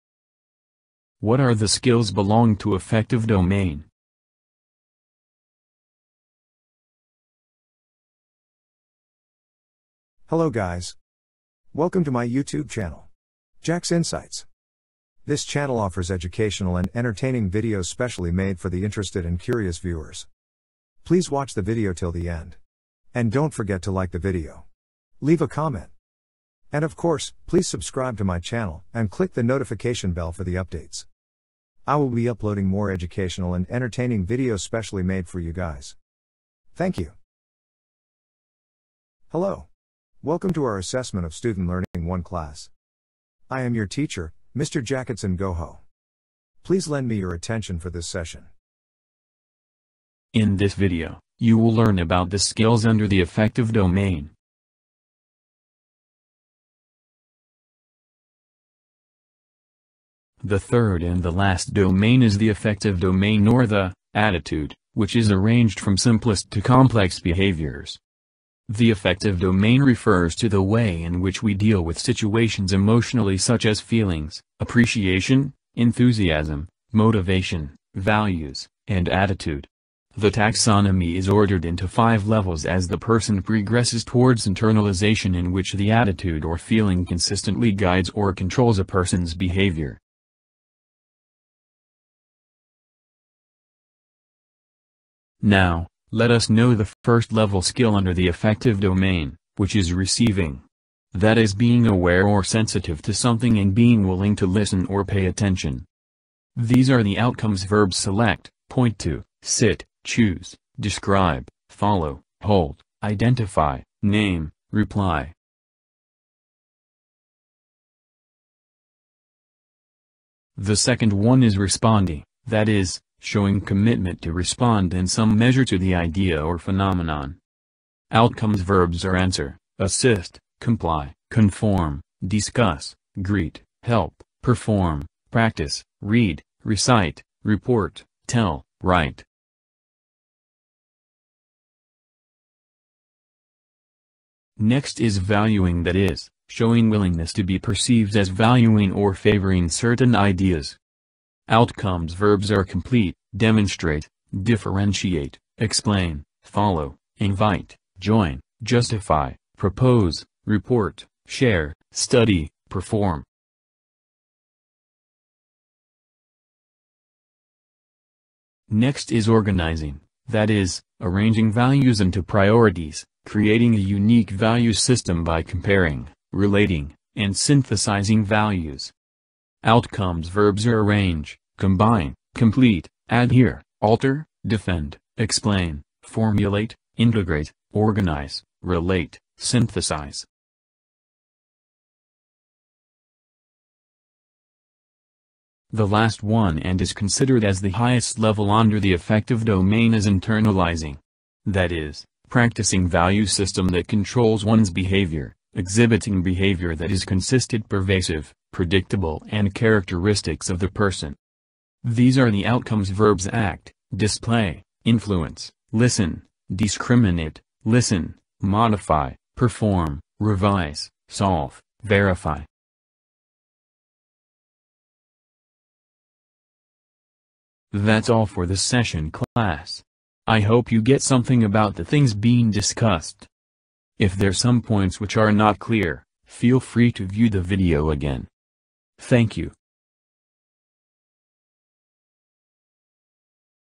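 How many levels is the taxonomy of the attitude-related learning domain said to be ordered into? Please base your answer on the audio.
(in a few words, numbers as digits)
5.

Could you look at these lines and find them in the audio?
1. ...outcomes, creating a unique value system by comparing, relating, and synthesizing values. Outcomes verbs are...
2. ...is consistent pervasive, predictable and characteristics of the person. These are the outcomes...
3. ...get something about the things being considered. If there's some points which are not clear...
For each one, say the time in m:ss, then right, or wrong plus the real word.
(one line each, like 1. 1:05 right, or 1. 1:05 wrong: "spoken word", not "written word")
1. 2:52 wrong: "priorities", not "outcomes"
2. 3:26 right
3. 3:50 wrong: "discussed", not "considered".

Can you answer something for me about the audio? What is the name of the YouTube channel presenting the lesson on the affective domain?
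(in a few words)
Jack's Insights.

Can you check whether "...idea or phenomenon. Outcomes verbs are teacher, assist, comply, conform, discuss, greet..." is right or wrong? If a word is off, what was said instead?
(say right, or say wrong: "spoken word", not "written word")
wrong: "answer", not "teacher".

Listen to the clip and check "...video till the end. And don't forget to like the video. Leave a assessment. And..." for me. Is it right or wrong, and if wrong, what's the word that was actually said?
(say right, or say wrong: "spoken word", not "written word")
wrong: "comment", not "assessment".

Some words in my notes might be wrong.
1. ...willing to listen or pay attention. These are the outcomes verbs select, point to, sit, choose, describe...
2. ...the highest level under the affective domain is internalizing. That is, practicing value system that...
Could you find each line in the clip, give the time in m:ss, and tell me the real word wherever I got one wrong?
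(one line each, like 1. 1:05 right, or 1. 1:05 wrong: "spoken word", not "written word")
1. 1:44 right
2. 3:17 right.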